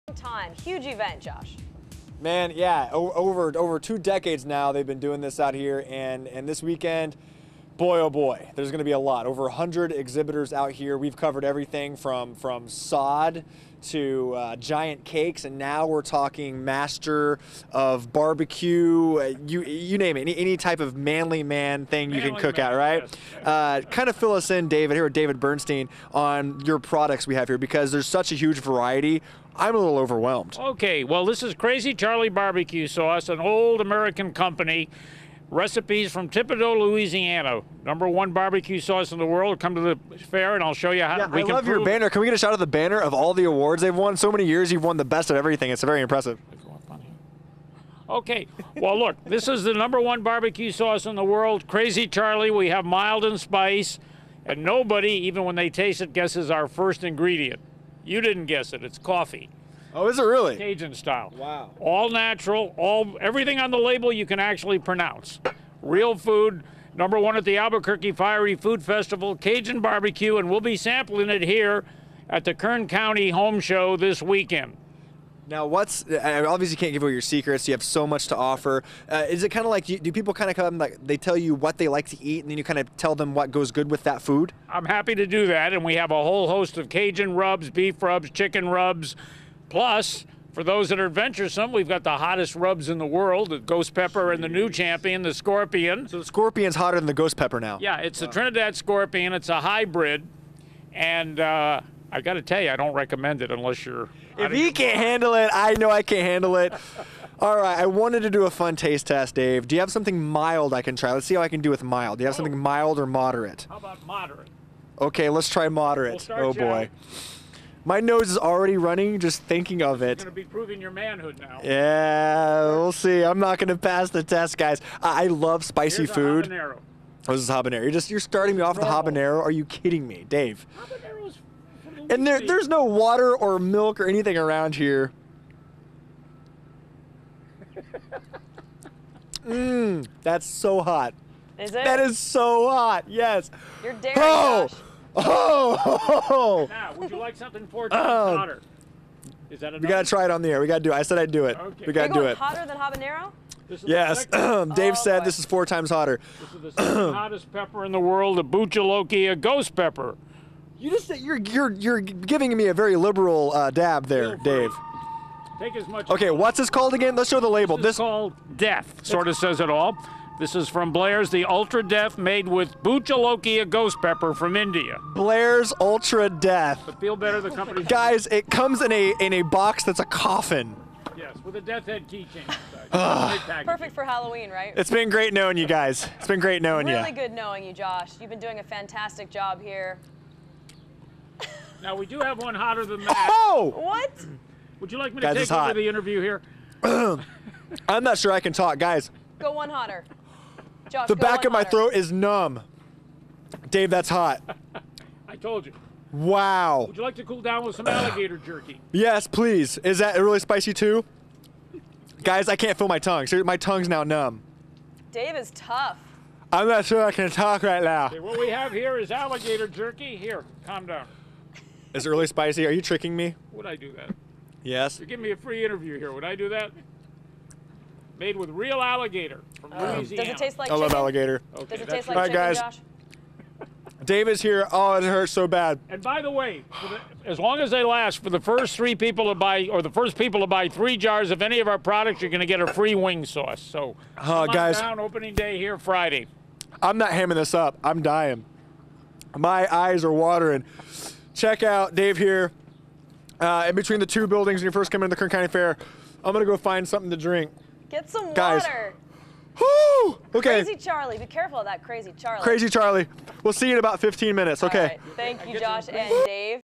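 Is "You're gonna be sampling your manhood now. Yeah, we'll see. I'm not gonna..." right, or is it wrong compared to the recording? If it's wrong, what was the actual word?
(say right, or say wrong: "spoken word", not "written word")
wrong: "proving", not "sampling".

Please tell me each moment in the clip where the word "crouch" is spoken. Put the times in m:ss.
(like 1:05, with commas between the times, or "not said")
not said.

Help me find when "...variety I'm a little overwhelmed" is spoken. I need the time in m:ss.
0:28.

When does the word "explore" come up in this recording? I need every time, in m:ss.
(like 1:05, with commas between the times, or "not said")
not said.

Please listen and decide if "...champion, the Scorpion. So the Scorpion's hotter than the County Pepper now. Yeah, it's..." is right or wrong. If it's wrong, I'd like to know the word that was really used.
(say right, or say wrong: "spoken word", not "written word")
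wrong: "Ghost", not "County".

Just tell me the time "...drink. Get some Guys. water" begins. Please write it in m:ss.
4:17.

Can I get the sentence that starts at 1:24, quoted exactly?
I'm happy to do that, and we have a whole host of Cajun rubs, beef rubs, chicken rubs.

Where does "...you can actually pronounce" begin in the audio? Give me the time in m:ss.
1:04.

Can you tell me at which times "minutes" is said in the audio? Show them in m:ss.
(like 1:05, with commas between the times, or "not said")
4:24.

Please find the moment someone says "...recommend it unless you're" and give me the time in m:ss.
1:42.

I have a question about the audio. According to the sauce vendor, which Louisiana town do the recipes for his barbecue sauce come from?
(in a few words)
Thibodaux.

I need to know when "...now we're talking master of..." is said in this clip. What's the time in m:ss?
0:15.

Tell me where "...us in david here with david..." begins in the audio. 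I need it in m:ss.
0:24.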